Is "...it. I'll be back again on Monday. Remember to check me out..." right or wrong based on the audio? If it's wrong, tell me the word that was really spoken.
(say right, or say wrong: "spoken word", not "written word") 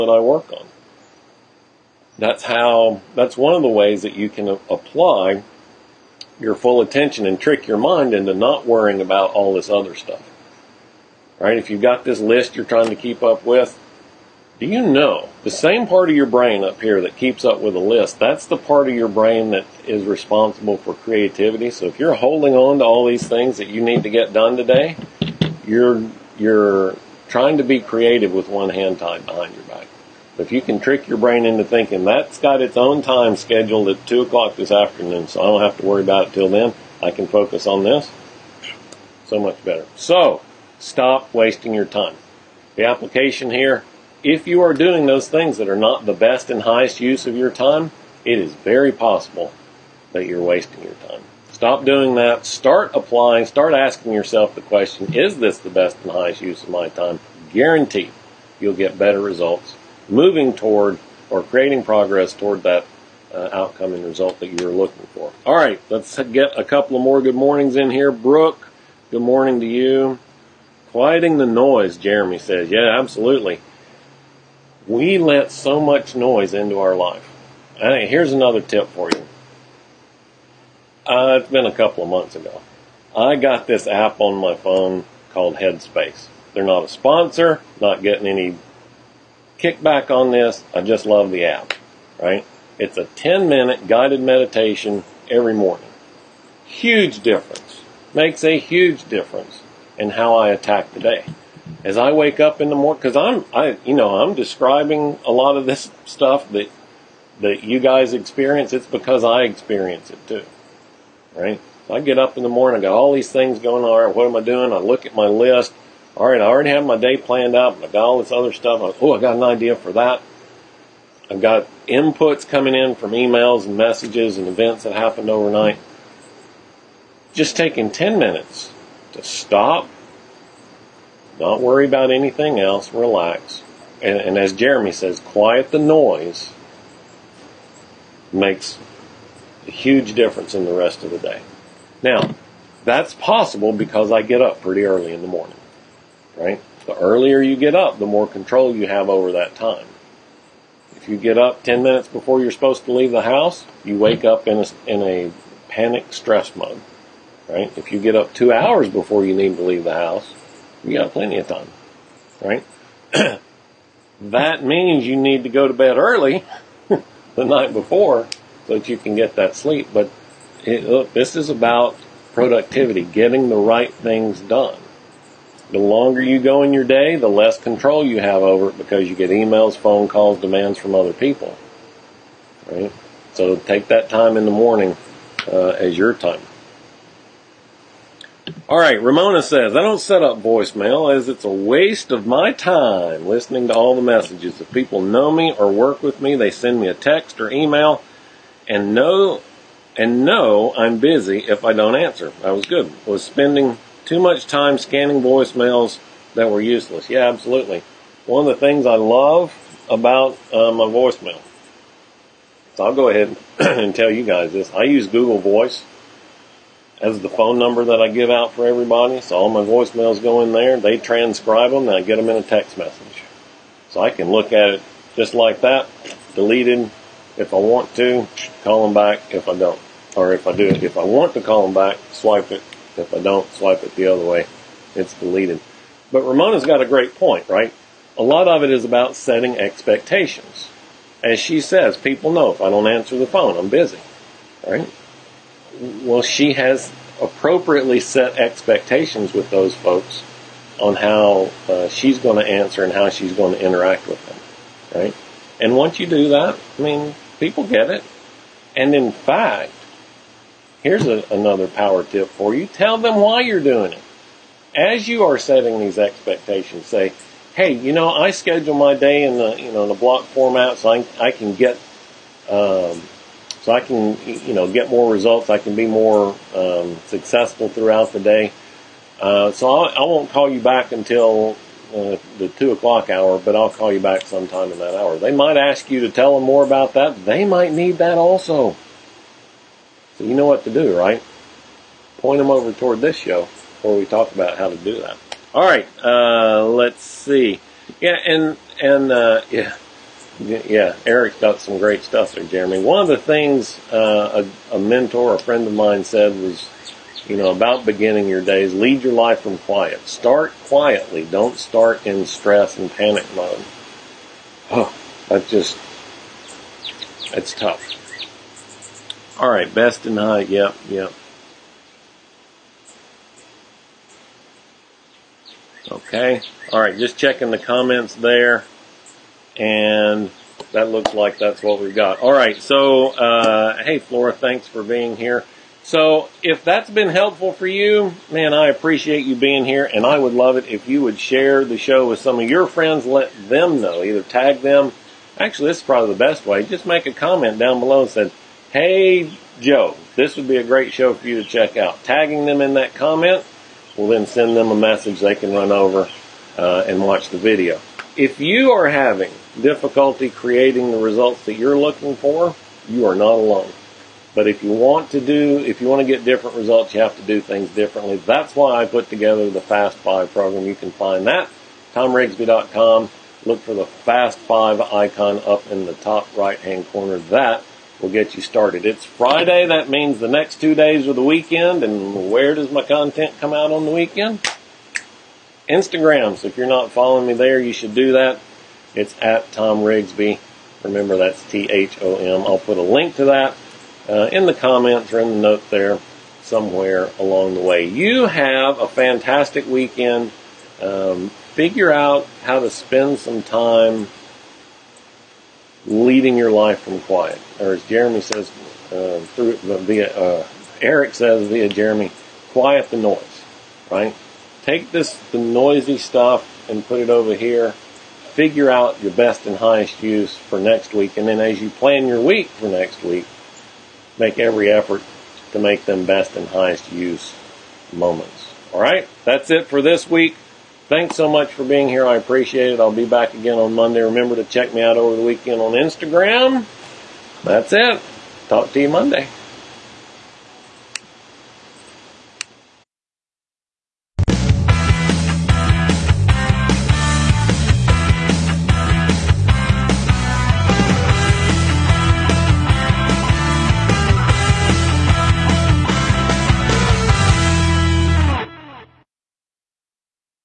right.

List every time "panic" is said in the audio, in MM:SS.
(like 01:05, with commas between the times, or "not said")
02:35, 05:12.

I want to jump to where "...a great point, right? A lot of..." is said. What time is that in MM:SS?
03:56.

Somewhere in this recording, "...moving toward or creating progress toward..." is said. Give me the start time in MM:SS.
01:00.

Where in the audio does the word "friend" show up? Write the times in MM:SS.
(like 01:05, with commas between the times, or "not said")
05:05, 05:42.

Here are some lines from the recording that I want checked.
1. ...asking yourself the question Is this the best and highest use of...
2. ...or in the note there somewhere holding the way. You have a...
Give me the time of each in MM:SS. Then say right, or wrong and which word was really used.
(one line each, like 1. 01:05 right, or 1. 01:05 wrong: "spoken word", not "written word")
1. 00:53 right
2. 06:35 wrong: "along", not "holding".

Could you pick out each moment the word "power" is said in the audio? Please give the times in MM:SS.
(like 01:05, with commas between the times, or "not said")
04:21.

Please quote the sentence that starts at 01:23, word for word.
I got this app on my phone called Headspace.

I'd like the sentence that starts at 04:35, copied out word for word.
I can be more um, successful throughout the day.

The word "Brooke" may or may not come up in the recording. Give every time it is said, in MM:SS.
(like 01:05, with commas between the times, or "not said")
01:08.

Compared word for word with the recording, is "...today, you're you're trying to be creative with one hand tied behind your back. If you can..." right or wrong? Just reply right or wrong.
right.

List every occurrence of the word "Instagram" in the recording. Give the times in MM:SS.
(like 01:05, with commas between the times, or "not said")
06:25, 07:15.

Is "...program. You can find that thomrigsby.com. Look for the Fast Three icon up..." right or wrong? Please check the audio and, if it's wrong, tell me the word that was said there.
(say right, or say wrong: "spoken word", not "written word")
wrong: "Five", not "Three".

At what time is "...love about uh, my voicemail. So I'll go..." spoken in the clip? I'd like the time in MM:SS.
03:28.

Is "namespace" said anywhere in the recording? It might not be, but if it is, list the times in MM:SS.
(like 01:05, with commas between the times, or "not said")
not said.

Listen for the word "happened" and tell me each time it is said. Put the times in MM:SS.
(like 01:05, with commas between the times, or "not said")
02:04.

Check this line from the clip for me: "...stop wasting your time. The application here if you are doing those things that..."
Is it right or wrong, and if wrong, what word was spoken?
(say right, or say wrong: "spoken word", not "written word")
right.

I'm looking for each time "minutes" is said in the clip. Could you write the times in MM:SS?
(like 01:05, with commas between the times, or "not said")
01:33, 02:08, 02:31.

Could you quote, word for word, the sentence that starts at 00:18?
That's the part of your brain that is responsible for creativity.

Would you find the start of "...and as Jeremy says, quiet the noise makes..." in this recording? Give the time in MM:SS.
02:14.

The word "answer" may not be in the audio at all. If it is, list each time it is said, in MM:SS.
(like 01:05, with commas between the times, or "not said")
03:21, 04:02, 04:12.